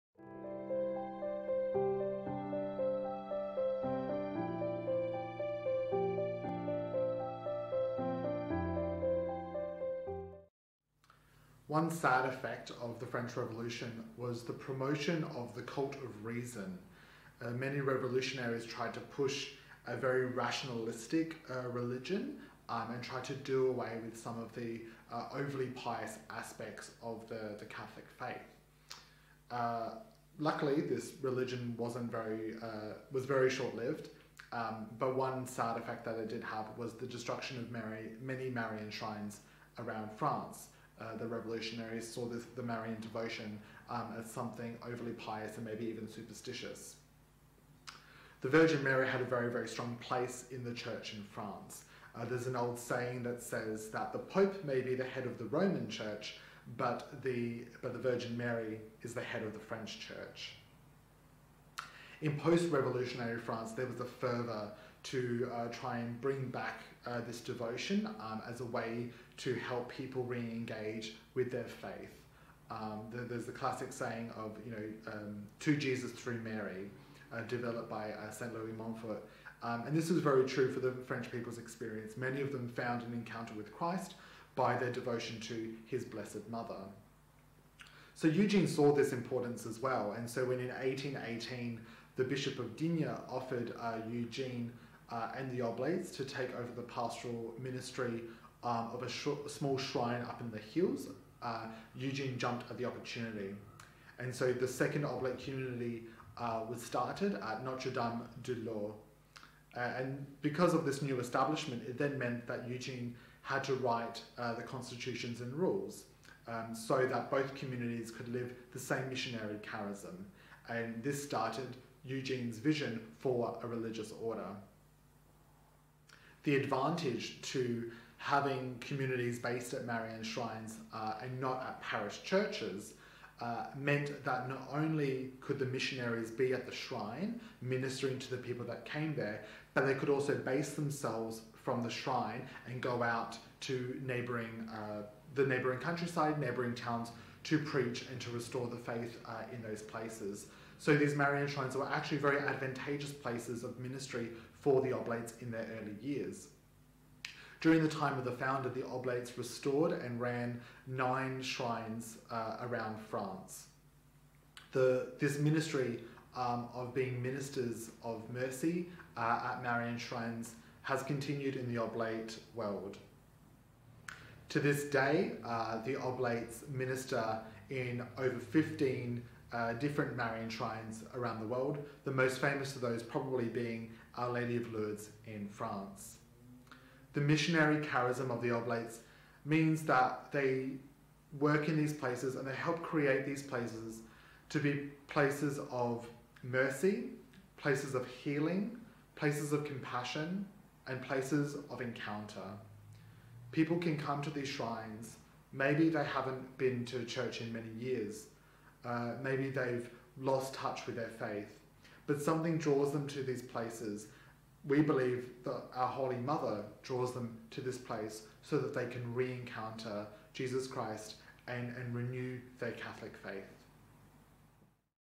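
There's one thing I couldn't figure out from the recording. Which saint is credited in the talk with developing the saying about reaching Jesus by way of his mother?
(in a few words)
St. Louis Montfort.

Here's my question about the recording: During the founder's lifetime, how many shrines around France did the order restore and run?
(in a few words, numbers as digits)
9.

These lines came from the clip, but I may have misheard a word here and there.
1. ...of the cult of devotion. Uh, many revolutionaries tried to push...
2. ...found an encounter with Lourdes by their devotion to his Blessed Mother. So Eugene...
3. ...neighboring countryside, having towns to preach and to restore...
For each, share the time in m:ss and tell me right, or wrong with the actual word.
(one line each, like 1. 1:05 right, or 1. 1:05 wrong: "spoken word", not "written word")
1. 0:15 wrong: "reason", not "devotion"
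2. 1:22 wrong: "Christ", not "Lourdes"
3. 2:25 wrong: "neighboring", not "having".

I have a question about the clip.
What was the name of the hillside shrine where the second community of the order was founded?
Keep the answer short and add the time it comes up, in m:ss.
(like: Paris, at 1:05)
Notre Dame de Laus, at 1:47.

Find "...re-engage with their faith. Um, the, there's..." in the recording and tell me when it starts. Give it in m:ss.
1:10.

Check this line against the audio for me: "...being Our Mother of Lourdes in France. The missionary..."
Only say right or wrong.
wrong.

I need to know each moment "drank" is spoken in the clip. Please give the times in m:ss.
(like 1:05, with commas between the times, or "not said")
not said.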